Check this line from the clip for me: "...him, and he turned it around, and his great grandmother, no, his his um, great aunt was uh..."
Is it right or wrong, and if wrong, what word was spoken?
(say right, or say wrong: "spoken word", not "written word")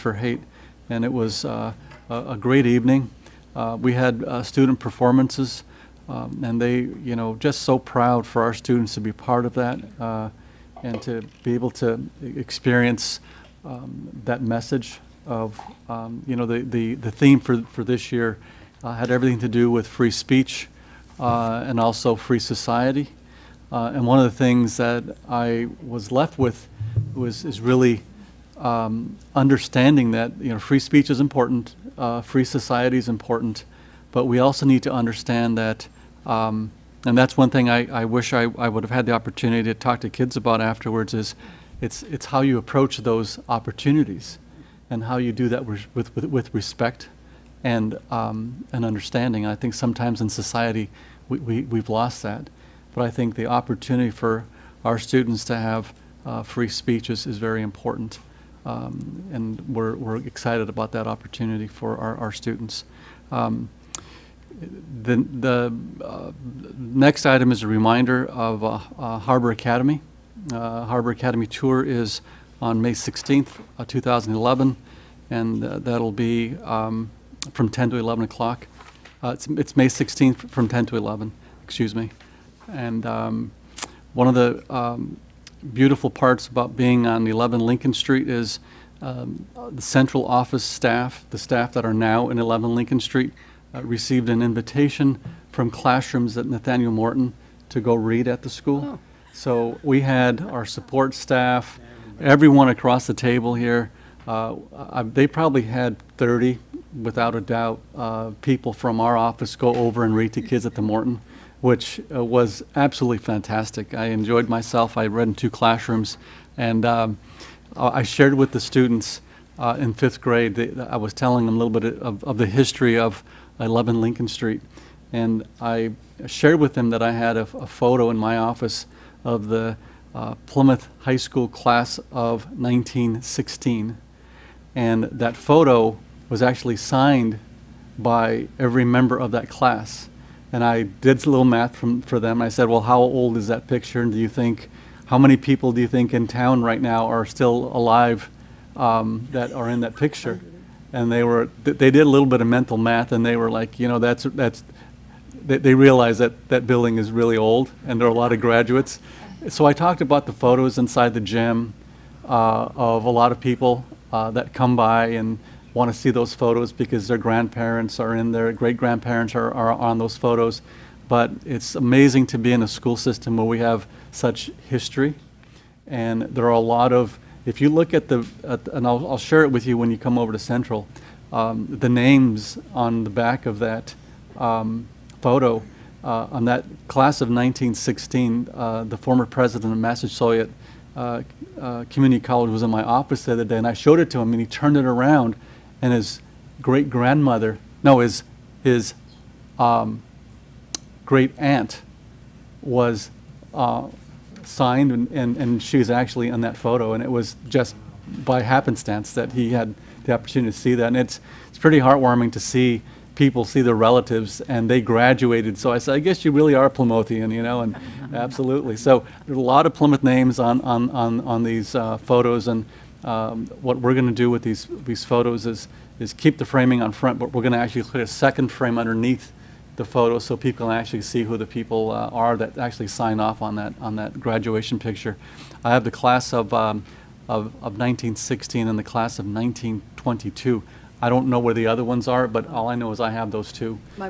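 right.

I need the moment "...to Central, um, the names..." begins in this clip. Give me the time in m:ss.
3:00.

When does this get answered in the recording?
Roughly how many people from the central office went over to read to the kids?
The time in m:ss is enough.
1:46.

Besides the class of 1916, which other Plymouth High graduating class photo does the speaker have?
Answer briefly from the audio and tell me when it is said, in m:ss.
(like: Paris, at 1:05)
1922, at 3:59.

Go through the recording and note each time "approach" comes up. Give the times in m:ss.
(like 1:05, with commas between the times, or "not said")
0:42.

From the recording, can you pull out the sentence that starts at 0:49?
I think sometimes in society we, we, we've lost that.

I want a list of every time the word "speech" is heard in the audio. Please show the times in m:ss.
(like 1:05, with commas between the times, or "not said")
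0:20, 0:30, 0:56.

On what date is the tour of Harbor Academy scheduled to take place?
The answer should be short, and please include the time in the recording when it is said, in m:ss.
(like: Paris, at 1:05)
May 16th, 2011, at 1:12.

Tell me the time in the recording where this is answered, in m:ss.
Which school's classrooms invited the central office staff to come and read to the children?
1:36.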